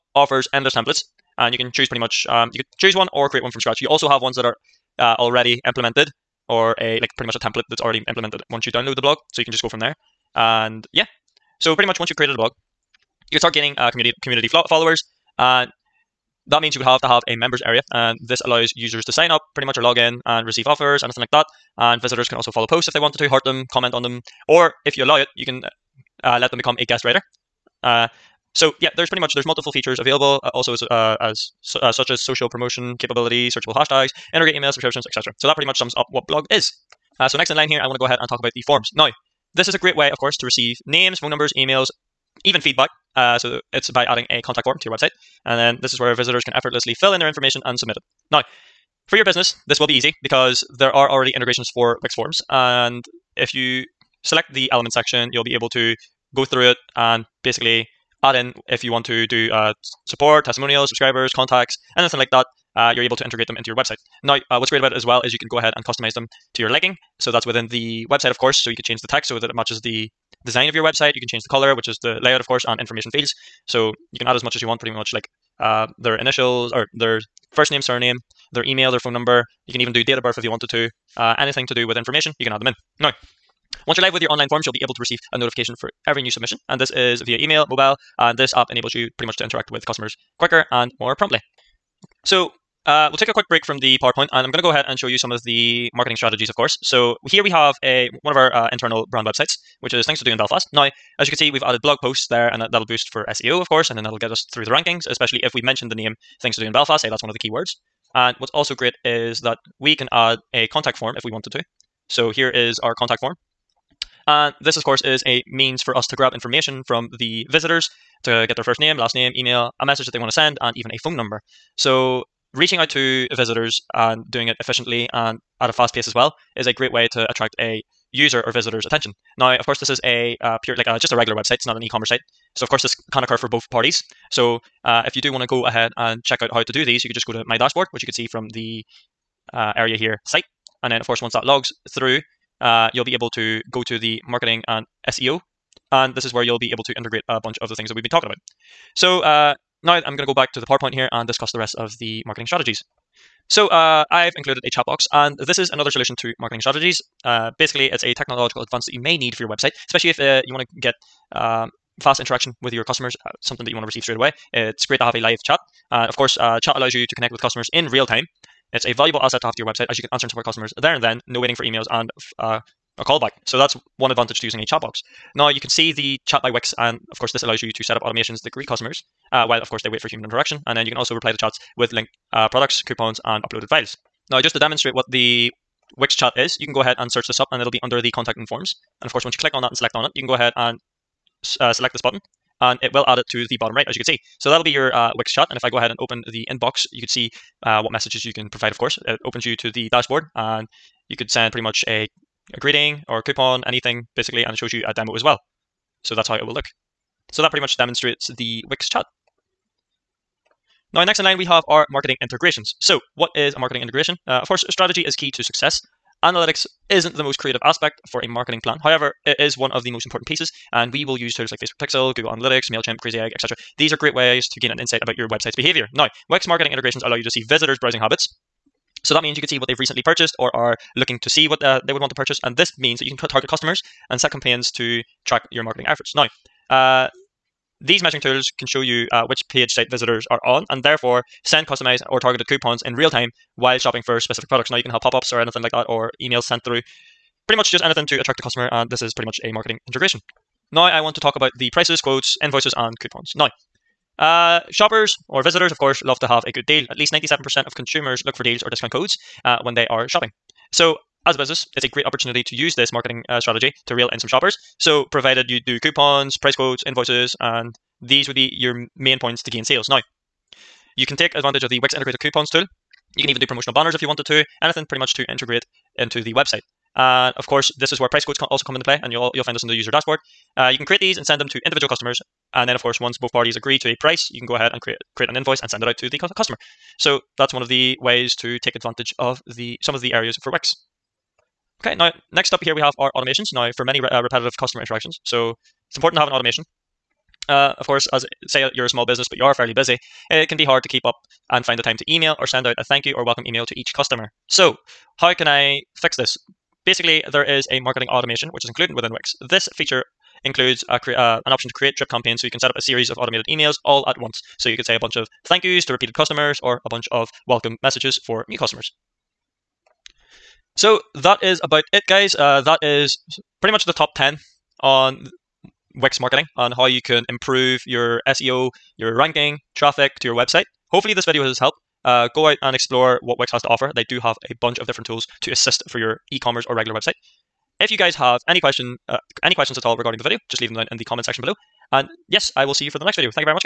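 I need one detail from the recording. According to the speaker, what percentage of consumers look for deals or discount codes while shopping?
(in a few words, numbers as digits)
97%.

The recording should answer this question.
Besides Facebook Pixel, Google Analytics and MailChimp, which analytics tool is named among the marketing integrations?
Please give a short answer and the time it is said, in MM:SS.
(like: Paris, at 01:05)
Crazy Egg, at 03:43.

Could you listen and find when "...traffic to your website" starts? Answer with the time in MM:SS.
05:29.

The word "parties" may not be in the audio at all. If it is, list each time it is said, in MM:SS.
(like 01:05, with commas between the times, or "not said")
02:13, 04:43.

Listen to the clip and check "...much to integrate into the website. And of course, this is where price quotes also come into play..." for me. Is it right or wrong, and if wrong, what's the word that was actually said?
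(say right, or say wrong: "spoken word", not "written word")
right.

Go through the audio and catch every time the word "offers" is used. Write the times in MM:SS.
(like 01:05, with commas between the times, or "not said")
00:00, 00:20, 05:33.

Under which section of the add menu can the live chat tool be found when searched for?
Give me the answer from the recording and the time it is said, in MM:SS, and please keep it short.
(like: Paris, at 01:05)
Contact and forms, at 03:08.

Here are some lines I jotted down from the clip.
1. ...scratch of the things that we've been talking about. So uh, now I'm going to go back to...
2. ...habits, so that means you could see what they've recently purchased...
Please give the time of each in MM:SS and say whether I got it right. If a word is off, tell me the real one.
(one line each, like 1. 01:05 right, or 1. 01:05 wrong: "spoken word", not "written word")
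1. 02:27 wrong: "bunch", not "scratch"
2. 03:47 right.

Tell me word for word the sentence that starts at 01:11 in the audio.
You can change the color, which is the layout, of course, and information fields.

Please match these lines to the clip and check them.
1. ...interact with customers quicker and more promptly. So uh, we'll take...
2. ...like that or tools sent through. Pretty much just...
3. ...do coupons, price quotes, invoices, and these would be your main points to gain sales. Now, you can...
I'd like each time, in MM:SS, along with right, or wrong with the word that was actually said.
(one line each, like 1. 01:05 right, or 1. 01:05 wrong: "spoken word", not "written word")
1. 01:29 right
2. 04:05 wrong: "emails", not "tools"
3. 04:25 right.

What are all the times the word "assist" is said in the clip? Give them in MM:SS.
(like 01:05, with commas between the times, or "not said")
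05:35.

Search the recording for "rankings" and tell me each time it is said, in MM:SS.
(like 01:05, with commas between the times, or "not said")
01:44, 05:29.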